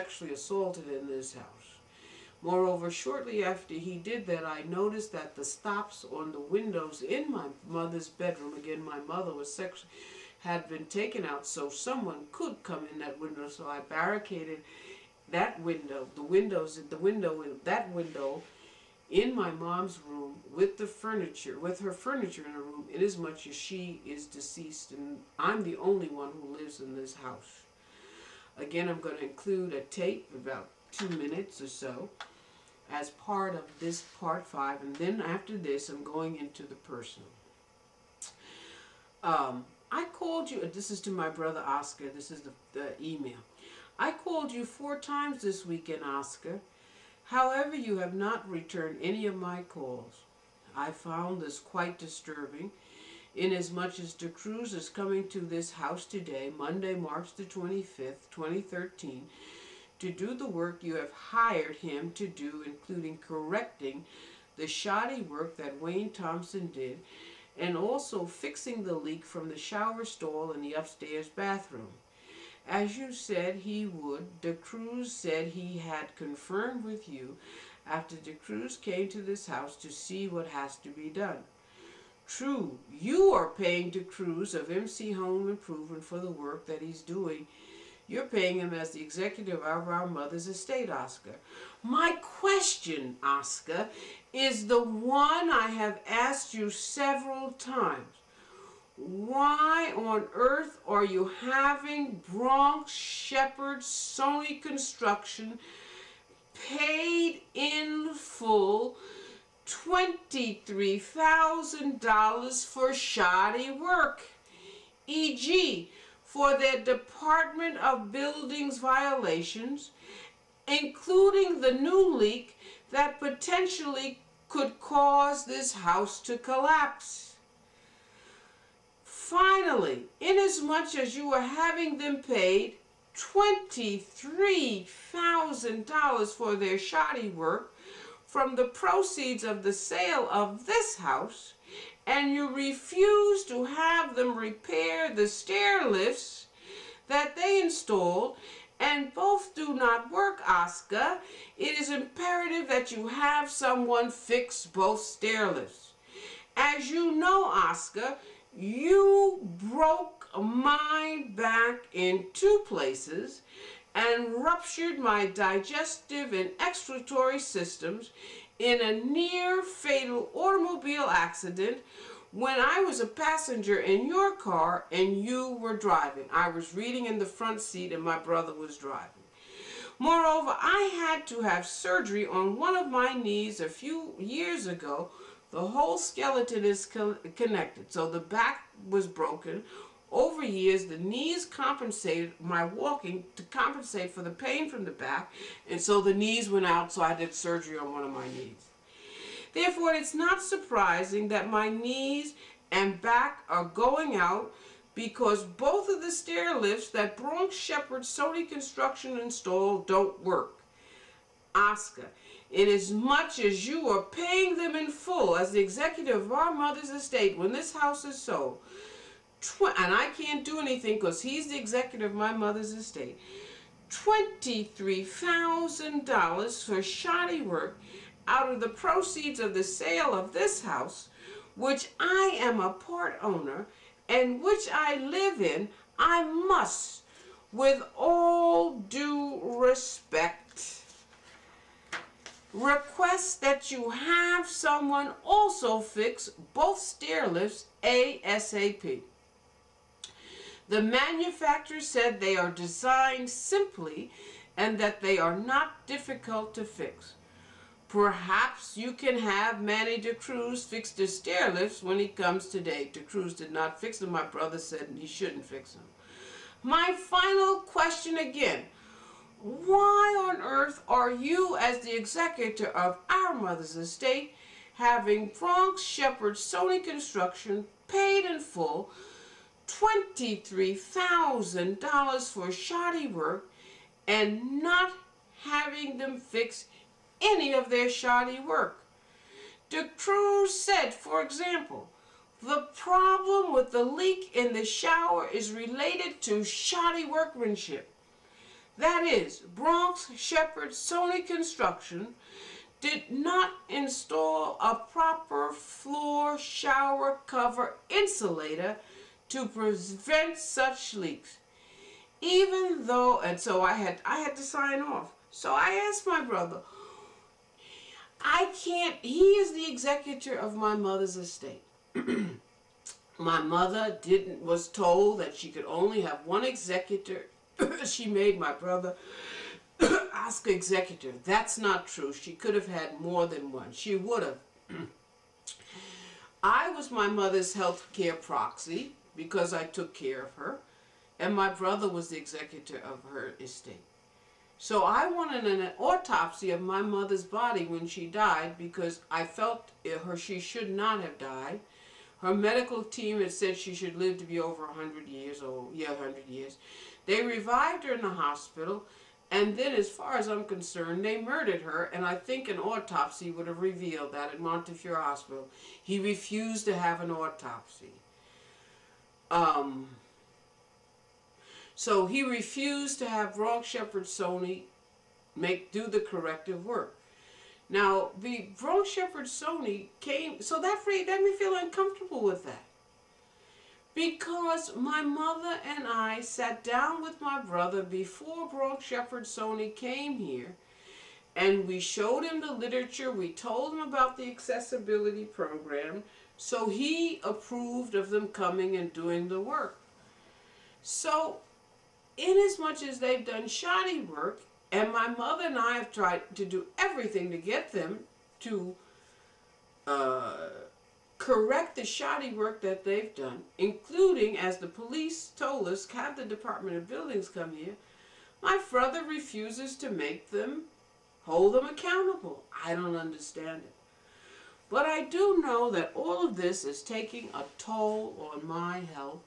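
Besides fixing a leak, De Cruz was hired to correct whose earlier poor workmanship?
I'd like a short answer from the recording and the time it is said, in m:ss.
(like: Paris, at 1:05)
Wayne Thompson, at 1:05.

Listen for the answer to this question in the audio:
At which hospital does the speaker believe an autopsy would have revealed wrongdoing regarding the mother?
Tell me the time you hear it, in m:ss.
6:04.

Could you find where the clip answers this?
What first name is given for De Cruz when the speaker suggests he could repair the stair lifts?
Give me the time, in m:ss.
4:19.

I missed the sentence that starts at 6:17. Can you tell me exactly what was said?
Now, the Bronx Shepherd Sony came, so that made me feel uncomfortable with that.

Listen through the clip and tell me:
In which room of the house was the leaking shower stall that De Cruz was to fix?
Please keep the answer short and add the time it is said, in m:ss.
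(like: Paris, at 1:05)
Upstairs bathroom, at 1:10.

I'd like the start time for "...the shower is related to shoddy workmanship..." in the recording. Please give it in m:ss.
4:54.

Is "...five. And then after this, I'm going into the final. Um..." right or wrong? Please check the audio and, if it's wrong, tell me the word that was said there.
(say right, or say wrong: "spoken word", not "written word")
wrong: "personal", not "final".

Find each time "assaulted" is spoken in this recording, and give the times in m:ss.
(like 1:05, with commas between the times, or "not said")
0:00.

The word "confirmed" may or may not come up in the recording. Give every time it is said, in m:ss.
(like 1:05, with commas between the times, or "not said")
1:16.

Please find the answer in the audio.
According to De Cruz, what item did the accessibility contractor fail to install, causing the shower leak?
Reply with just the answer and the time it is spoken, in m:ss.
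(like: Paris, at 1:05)
Floor shower cover insulator, at 5:05.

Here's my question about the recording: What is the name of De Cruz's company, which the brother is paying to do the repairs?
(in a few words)
MC Home Improvement.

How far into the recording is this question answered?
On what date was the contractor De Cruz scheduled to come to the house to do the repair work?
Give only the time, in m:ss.
0:56.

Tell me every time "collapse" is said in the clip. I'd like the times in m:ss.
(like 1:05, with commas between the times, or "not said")
2:06.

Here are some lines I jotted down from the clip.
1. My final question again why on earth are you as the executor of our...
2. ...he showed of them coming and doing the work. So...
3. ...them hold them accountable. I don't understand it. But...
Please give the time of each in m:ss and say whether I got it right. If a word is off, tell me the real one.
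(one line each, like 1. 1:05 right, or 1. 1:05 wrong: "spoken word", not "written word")
1. 4:26 right
2. 6:36 wrong: "approved", not "showed"
3. 7:00 right.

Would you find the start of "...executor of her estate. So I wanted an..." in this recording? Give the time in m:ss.
5:42.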